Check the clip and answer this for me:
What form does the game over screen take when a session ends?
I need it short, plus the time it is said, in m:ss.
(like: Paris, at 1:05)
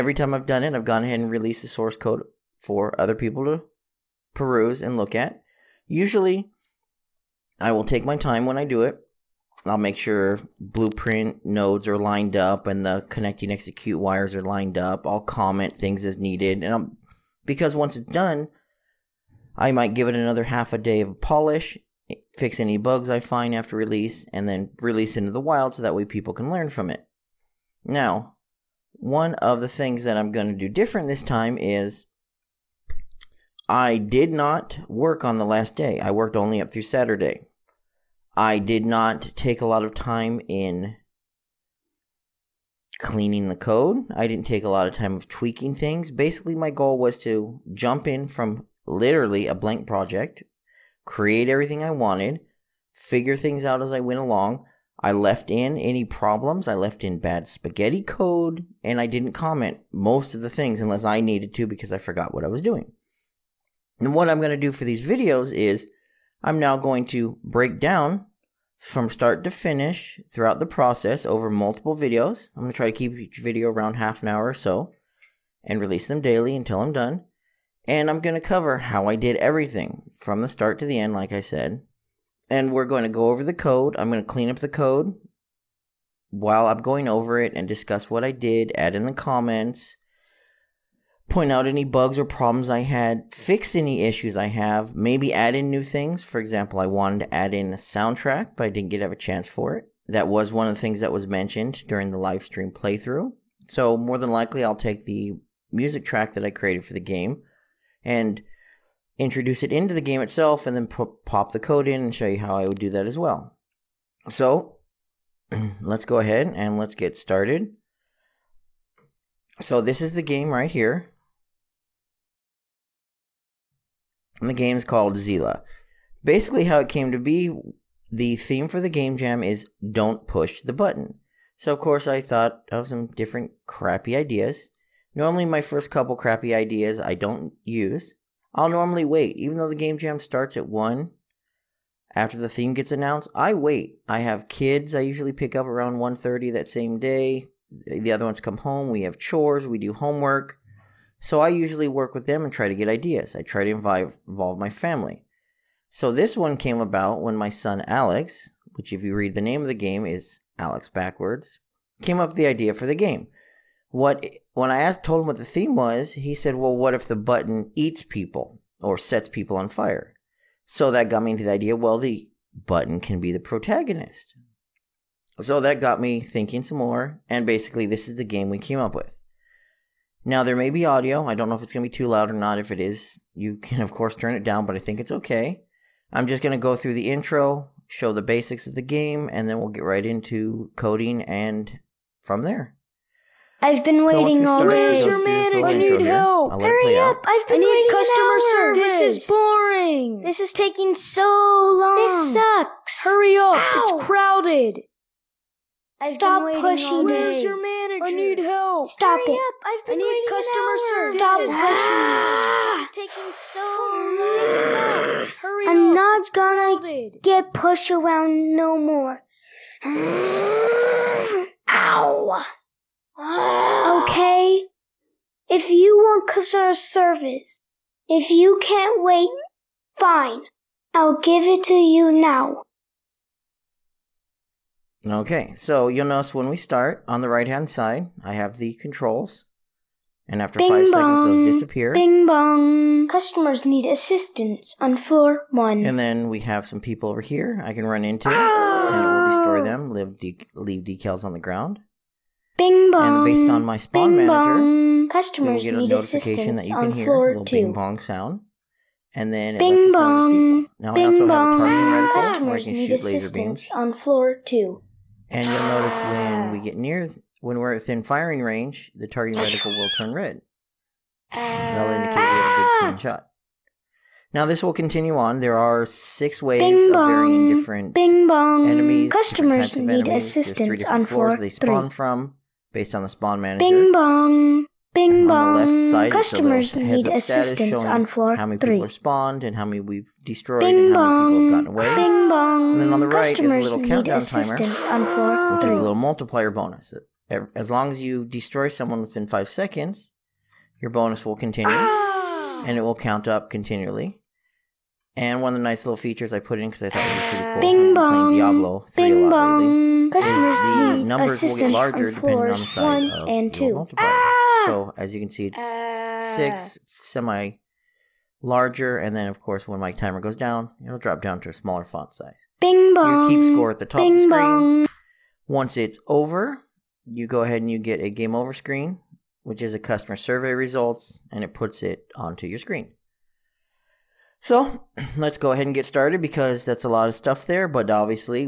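Customer survey results, at 5:29.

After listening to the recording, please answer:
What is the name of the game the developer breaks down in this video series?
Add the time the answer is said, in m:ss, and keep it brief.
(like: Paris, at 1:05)
Zila, at 2:05.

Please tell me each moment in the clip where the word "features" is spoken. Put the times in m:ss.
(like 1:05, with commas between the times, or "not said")
5:05.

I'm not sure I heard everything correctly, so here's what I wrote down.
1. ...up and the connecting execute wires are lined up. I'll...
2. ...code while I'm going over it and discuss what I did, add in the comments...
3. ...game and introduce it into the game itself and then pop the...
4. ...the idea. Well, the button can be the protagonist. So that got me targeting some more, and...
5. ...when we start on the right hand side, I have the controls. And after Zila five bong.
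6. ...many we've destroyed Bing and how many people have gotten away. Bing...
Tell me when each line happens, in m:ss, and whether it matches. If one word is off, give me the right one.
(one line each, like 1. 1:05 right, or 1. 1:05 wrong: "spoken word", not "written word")
1. 0:12 right
2. 1:24 right
3. 1:47 right
4. 2:51 wrong: "thinking", not "targeting"
5. 3:56 wrong: "Bing", not "Zila"
6. 4:49 right.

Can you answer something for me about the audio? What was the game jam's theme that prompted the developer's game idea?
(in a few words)
Don't push the button.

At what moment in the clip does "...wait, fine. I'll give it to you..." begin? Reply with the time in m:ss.
3:49.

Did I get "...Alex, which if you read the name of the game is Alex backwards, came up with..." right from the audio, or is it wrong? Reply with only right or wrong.
right.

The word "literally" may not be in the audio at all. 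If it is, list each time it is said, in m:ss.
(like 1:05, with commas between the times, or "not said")
0:48.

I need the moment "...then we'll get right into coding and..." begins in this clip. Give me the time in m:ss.
3:09.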